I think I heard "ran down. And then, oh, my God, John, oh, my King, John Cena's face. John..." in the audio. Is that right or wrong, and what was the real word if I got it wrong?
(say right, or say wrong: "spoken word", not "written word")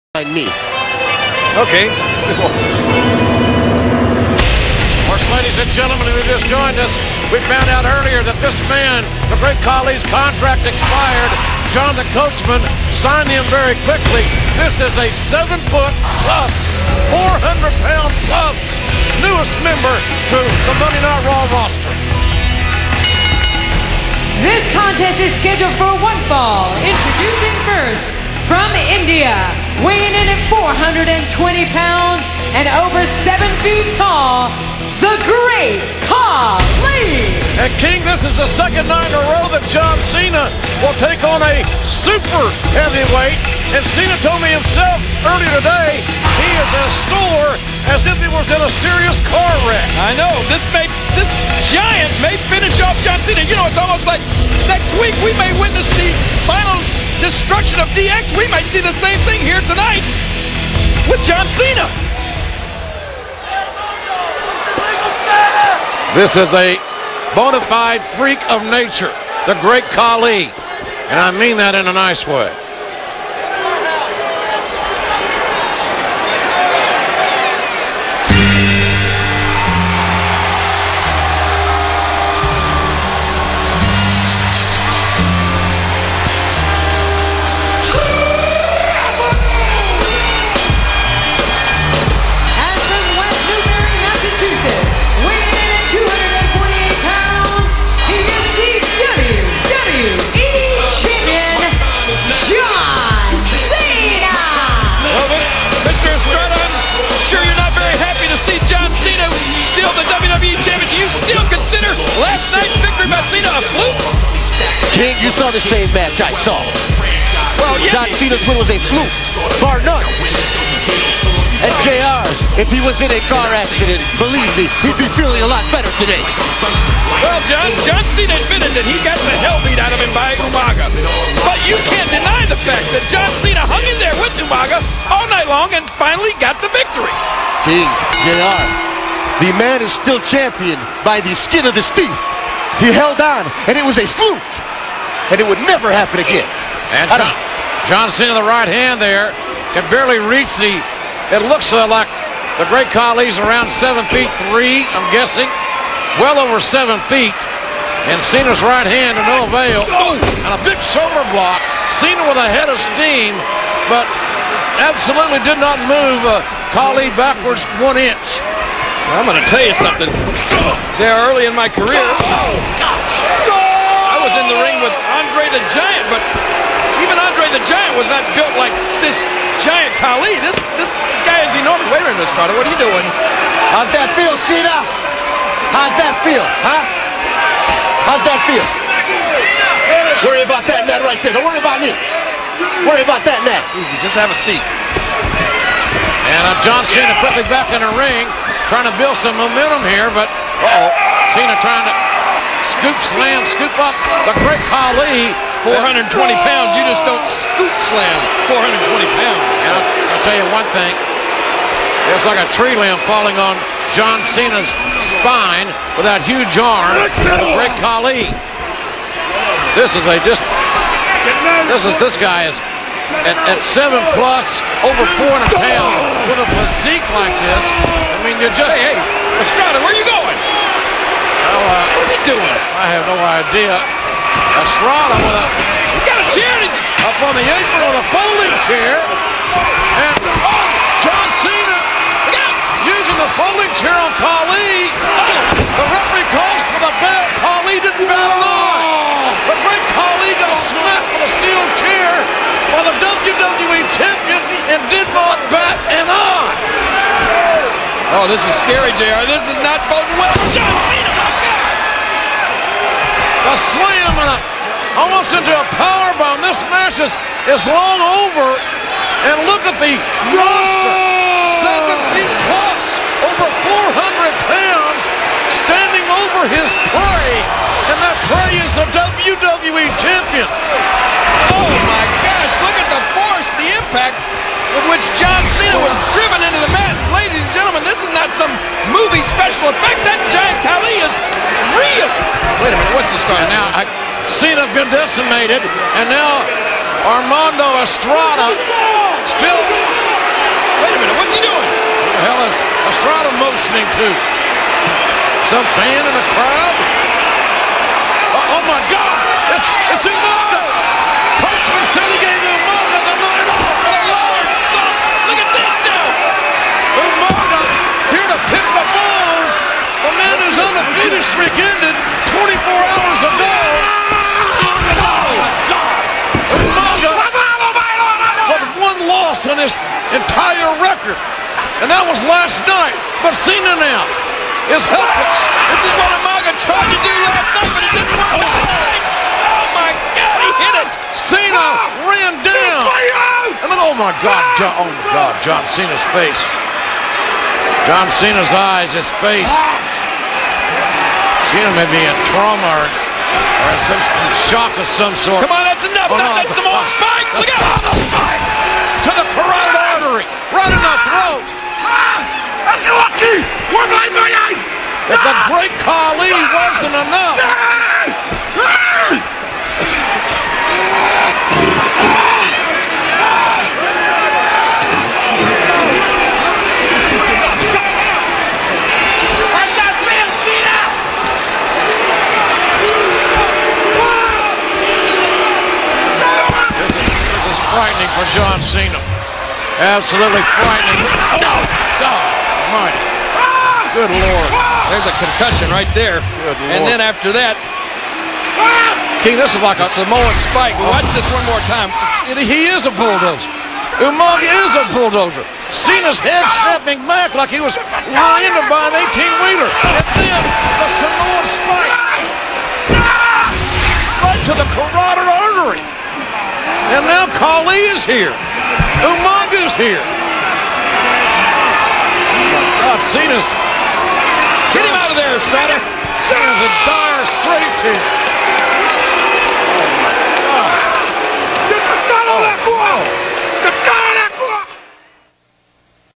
wrong: "God", not "King".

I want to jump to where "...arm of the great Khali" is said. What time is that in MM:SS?
03:36.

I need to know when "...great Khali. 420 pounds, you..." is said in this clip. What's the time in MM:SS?
03:24.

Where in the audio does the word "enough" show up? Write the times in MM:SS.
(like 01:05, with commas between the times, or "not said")
05:10, 05:55, 06:06.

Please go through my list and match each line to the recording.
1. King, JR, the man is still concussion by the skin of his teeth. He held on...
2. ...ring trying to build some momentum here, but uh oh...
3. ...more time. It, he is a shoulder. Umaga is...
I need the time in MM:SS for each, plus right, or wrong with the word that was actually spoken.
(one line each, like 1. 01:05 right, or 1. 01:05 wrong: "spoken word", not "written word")
1. 02:17 wrong: "champion", not "concussion"
2. 03:17 right
3. 06:41 wrong: "bulldozer", not "shoulder".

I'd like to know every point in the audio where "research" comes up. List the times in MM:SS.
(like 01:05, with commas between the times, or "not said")
not said.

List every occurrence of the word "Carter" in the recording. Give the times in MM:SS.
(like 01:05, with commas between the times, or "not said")
03:02.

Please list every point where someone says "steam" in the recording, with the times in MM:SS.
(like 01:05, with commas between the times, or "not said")
02:42.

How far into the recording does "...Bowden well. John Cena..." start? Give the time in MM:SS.
04:19.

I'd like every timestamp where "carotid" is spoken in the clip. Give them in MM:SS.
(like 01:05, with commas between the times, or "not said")
05:59.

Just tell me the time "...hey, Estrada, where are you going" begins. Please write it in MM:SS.
03:48.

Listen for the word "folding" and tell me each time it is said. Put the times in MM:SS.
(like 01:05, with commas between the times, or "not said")
03:58, 04:03.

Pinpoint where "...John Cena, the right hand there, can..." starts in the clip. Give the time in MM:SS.
02:27.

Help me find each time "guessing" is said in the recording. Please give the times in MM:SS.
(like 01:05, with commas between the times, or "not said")
02:35.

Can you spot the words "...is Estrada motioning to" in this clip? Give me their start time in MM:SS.
05:02.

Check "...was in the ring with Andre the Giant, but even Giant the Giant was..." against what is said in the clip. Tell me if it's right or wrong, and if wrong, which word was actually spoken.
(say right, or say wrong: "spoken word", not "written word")
wrong: "Andre", not "Giant".